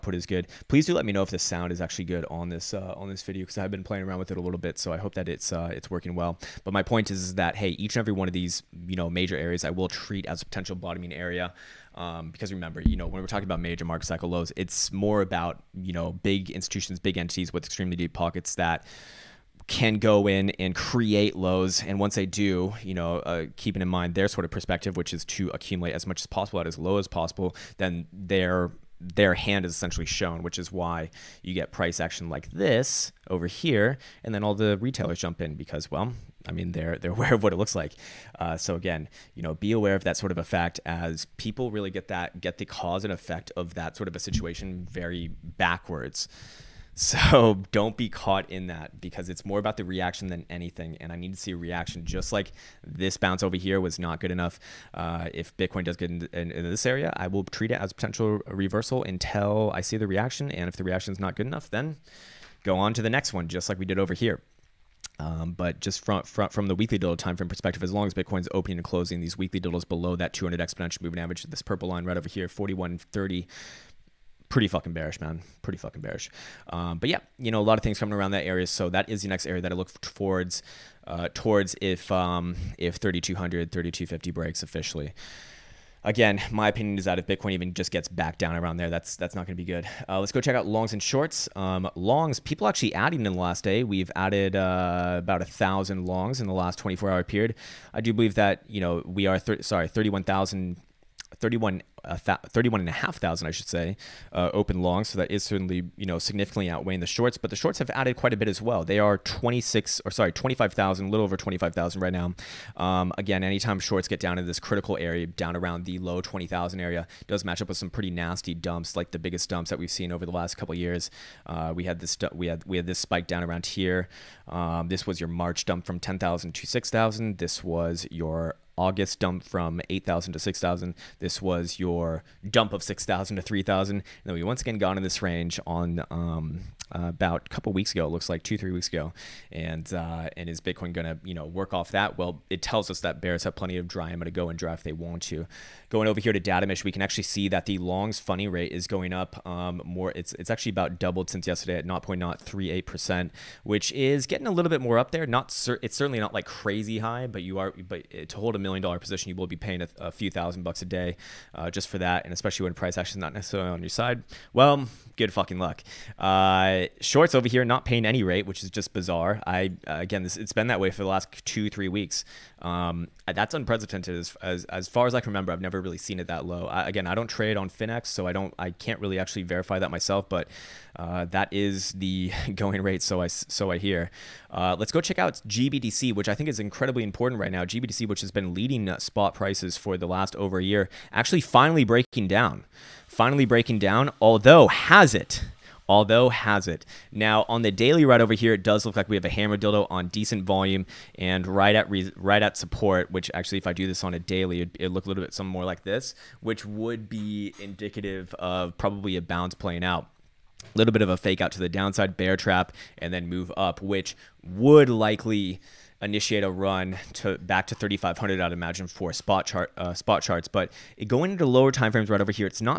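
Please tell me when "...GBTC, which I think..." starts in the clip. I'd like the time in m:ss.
3:05.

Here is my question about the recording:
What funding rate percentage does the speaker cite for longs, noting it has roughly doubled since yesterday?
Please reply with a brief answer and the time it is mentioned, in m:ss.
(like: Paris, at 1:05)
0.038%, at 2:31.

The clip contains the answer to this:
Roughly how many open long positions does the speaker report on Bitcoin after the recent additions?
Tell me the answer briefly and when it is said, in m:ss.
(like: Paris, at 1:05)
31,500, at 1:42.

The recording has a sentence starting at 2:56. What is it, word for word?
I, again, I don't trade on Finex, so I don't, I can't really actually verify that myself.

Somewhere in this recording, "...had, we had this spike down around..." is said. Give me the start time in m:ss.
2:02.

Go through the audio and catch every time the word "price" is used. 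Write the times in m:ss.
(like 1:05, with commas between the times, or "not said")
0:31, 2:42, 3:09.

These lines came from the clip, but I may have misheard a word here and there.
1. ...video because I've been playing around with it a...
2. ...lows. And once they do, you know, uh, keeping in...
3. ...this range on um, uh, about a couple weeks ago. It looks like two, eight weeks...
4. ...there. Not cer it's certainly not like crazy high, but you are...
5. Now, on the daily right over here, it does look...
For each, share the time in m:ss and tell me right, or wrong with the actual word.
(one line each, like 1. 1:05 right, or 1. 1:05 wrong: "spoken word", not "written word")
1. 0:03 right
2. 0:21 right
3. 2:15 wrong: "three", not "eight"
4. 2:35 right
5. 3:17 right.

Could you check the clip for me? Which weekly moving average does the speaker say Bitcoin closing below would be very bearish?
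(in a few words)
200 exponential moving average.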